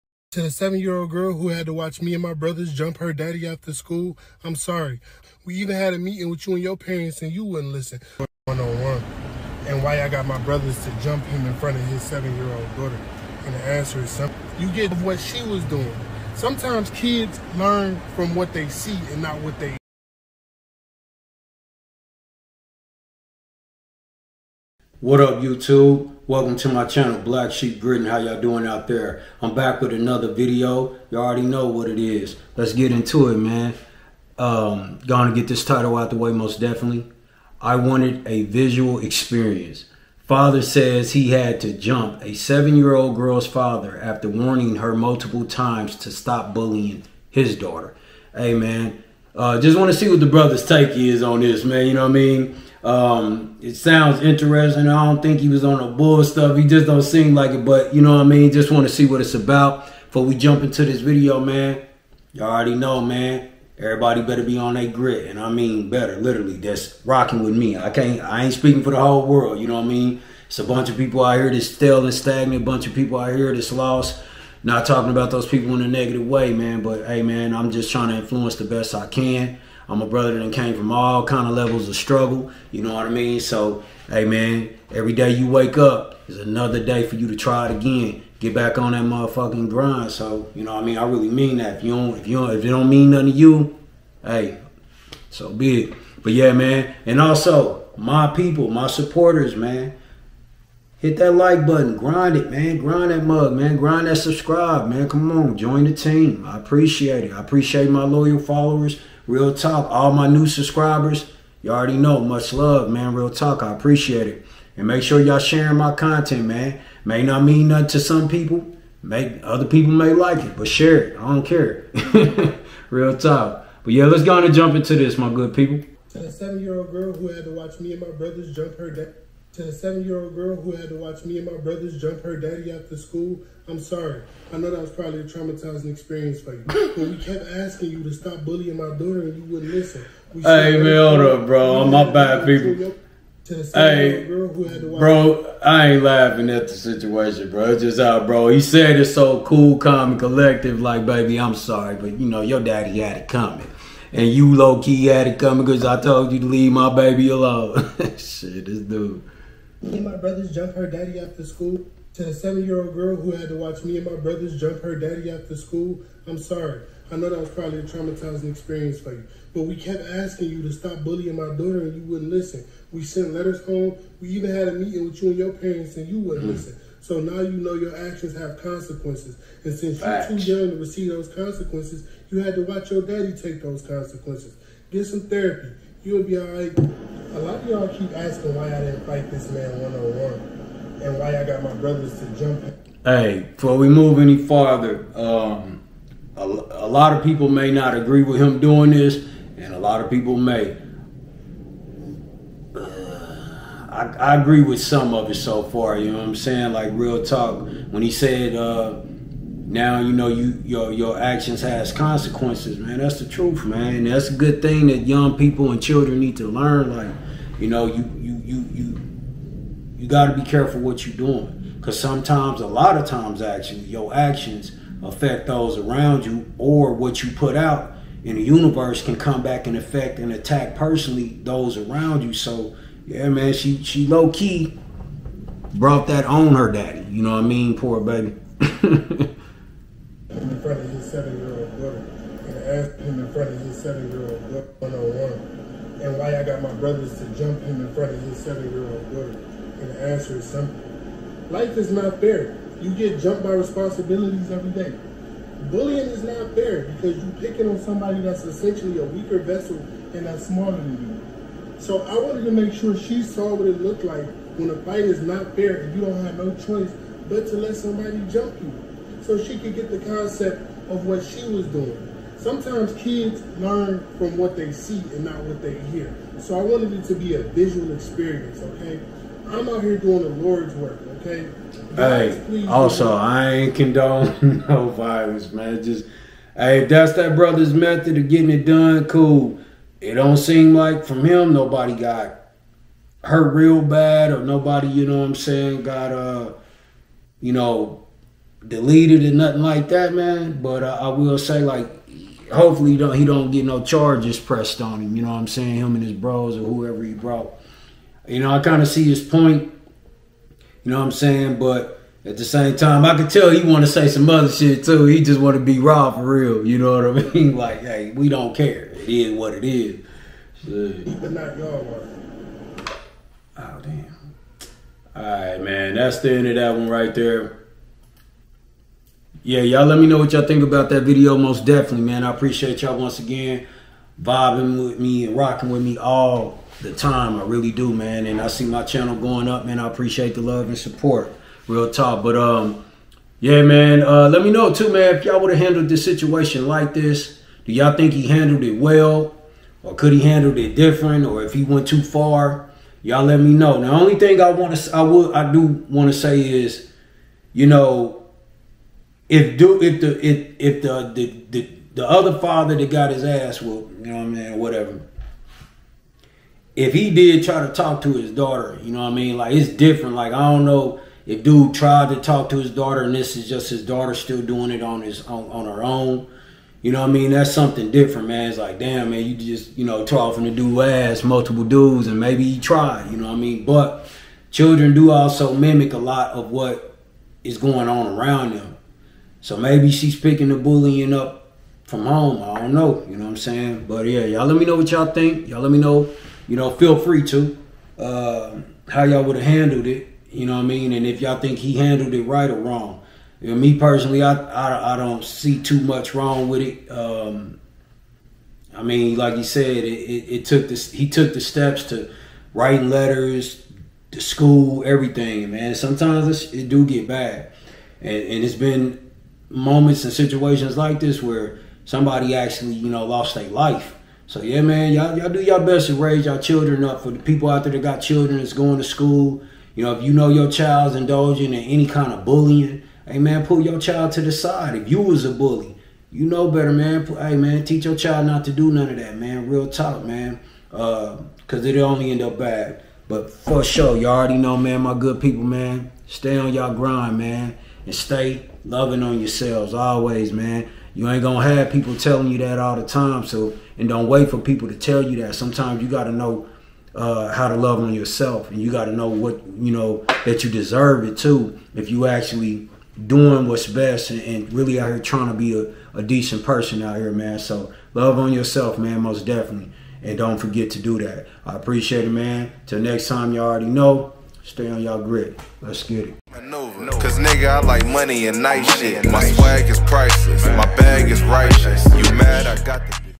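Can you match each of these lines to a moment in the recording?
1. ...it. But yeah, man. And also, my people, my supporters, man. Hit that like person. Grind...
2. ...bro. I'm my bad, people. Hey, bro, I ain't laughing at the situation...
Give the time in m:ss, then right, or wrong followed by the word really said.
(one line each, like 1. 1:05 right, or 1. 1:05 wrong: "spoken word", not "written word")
1. 1:35 wrong: "button", not "person"
2. 2:21 right.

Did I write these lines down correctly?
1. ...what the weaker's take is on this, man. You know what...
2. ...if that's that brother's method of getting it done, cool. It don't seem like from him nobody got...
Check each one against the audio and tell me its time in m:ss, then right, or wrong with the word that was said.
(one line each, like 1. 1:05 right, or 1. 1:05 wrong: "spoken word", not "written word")
1. 0:50 wrong: "brother", not "weaker"
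2. 4:46 right.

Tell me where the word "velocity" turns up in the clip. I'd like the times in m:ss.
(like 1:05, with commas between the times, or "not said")
not said.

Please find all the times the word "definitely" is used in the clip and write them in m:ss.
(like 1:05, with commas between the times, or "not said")
0:36, 5:31, 7:49.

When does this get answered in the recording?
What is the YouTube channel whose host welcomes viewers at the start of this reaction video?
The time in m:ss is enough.
0:27.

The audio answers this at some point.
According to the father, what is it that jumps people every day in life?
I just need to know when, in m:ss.
4:13.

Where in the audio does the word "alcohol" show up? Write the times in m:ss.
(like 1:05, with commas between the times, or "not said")
not said.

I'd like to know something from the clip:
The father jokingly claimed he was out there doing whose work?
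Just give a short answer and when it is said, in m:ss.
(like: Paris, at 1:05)
the Lord's, at 4:40.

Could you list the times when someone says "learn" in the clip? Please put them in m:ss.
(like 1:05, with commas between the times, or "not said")
0:17, 3:36, 4:33.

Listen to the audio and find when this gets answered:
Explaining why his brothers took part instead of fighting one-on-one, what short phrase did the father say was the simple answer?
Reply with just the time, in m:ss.
4:11.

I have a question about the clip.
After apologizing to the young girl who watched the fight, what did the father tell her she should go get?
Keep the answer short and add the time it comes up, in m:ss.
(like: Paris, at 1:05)
therapy, at 3:05.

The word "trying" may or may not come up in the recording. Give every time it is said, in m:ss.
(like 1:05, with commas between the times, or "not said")
1:17, 7:44.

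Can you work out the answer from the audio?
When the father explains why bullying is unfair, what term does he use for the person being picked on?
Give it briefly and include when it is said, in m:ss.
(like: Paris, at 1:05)
weaker vessel, at 4:19.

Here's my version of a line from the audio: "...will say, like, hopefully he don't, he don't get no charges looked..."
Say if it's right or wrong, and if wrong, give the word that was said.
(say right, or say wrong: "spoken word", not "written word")
wrong: "pressed", not "looked".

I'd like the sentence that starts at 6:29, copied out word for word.
So maybe she's picking the bullying up from home.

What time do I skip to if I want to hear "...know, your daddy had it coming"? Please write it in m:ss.
2:32.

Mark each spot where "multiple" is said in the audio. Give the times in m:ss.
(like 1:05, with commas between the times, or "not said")
0:44, 6:21.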